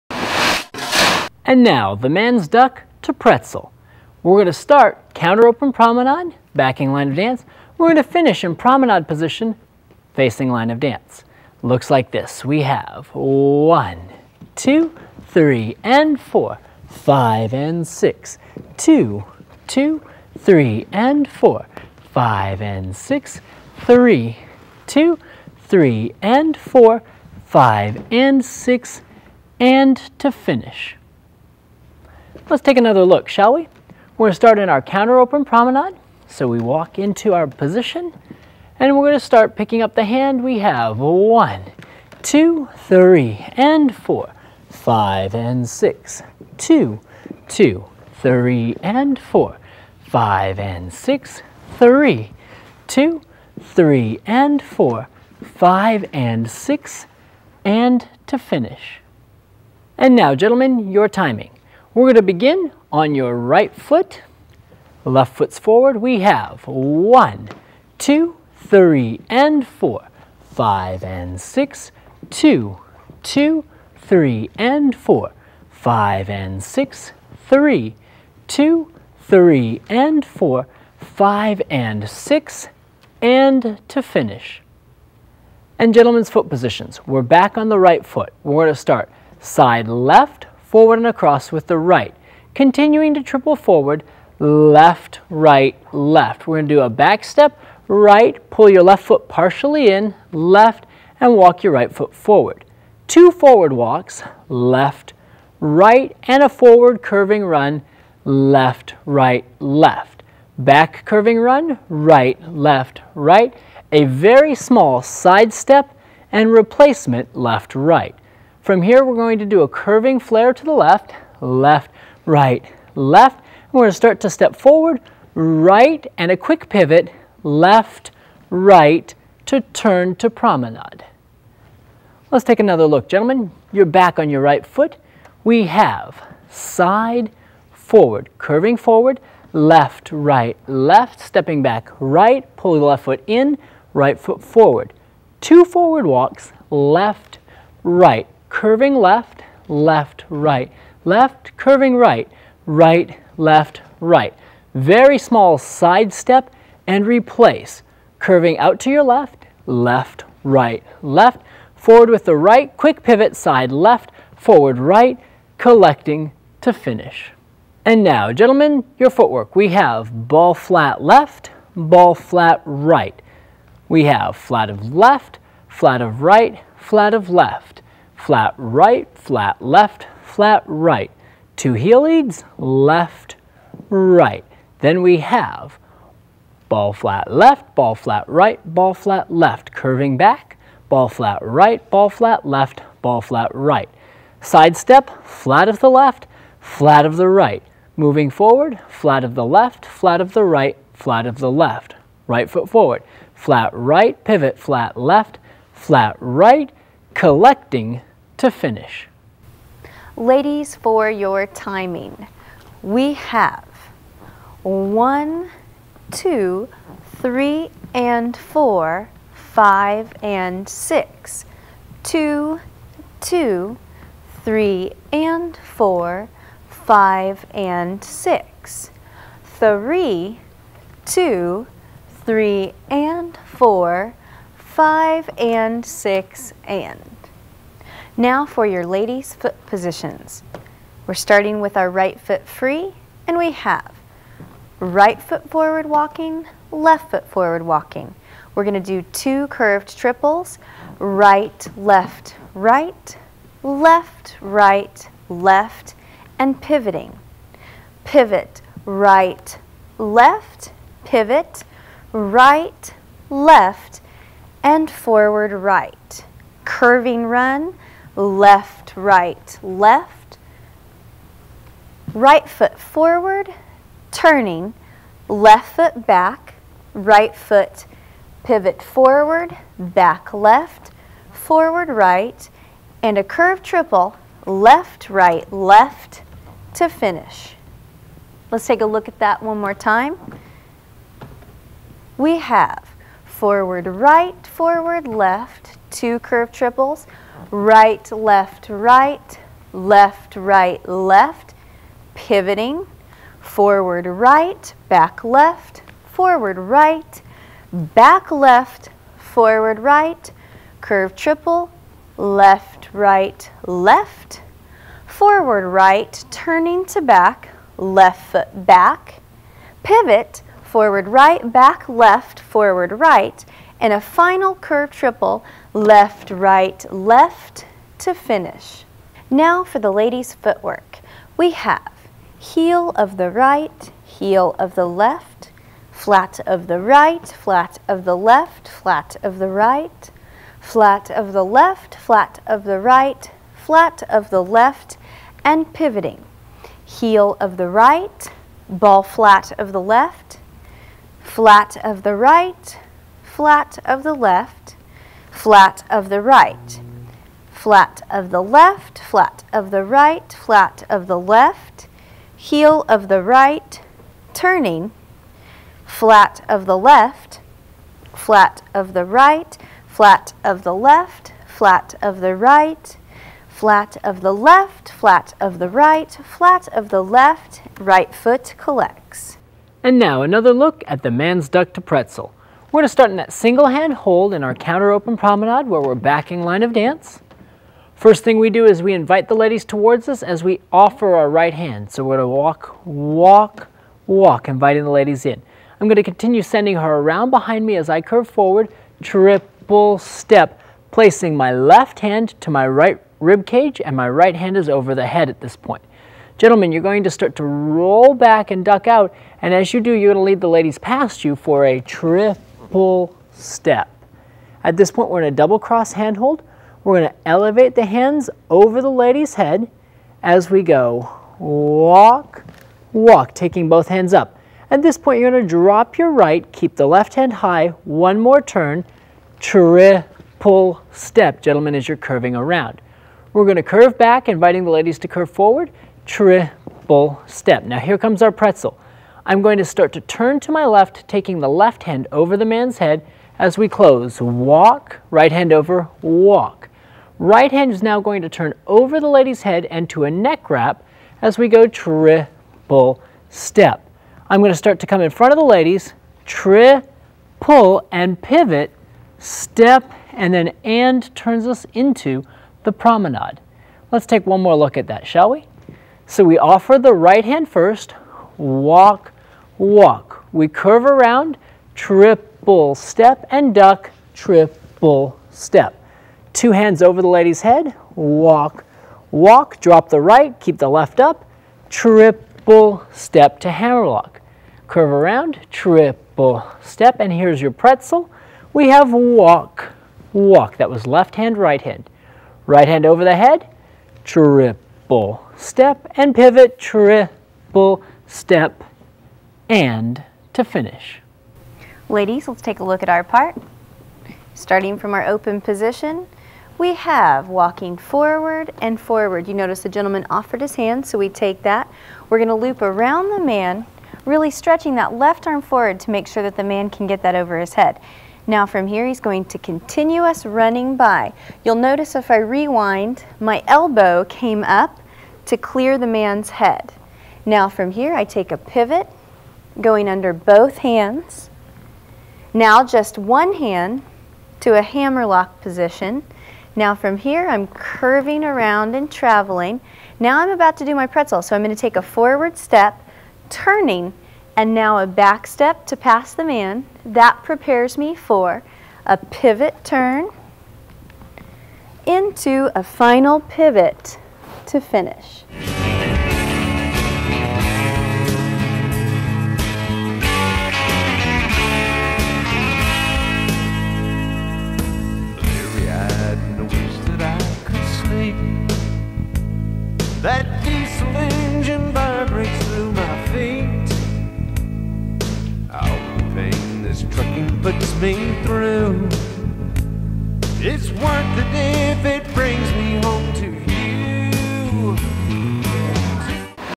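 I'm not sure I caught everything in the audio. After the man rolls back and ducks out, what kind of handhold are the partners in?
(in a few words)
Double cross handhold.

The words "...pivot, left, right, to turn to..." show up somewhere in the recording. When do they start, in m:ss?
2:06.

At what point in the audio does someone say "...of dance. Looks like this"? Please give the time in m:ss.
0:10.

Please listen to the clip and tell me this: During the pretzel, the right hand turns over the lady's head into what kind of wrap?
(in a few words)
Neck wrap.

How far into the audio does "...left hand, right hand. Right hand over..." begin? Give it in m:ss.
8:10.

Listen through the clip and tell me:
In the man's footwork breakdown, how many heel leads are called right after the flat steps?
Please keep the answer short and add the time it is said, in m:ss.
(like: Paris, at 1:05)
2, at 3:01.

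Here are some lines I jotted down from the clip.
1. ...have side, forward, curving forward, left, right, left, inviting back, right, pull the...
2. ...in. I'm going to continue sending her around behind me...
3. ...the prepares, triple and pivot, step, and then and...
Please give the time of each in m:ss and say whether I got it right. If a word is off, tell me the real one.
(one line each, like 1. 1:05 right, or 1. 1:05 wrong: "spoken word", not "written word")
1. 2:15 wrong: "stepping", not "inviting"
2. 6:35 right
3. 7:35 wrong: "ladies", not "prepares".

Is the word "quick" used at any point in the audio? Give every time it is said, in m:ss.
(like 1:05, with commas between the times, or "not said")
2:06, 2:42.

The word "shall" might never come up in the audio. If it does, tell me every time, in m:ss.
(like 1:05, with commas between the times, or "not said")
0:33, 7:45.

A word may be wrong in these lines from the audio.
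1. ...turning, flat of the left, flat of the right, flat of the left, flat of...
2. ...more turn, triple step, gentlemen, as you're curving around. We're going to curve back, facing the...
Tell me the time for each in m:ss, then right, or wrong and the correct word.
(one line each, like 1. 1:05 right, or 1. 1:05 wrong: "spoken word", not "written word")
1. 6:04 right
2. 7:08 wrong: "inviting", not "facing".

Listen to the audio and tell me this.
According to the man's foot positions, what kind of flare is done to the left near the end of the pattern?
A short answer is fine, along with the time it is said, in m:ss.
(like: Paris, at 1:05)
Curving flare, at 1:59.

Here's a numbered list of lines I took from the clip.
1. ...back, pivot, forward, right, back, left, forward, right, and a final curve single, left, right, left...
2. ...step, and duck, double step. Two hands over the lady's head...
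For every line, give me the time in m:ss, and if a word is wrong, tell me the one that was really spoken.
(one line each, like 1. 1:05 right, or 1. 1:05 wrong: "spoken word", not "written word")
1. 5:18 wrong: "triple", not "single"
2. 7:52 wrong: "triple", not "double".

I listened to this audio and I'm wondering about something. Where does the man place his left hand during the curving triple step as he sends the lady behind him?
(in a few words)
Right rib cage.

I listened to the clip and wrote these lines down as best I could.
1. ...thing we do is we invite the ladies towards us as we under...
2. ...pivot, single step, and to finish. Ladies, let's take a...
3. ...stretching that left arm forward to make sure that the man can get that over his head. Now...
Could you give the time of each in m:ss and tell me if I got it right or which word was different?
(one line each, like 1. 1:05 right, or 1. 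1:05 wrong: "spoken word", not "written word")
1. 6:28 wrong: "offer", not "under"
2. 8:16 wrong: "triple", not "single"
3. 8:34 right.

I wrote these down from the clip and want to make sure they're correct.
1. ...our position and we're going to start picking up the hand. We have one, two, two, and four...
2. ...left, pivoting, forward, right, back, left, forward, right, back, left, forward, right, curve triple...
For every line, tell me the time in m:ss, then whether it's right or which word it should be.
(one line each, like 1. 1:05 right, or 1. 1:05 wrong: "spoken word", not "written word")
1. 0:37 wrong: "three", not "two"
2. 5:00 right.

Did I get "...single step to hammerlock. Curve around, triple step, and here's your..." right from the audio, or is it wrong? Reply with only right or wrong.
wrong.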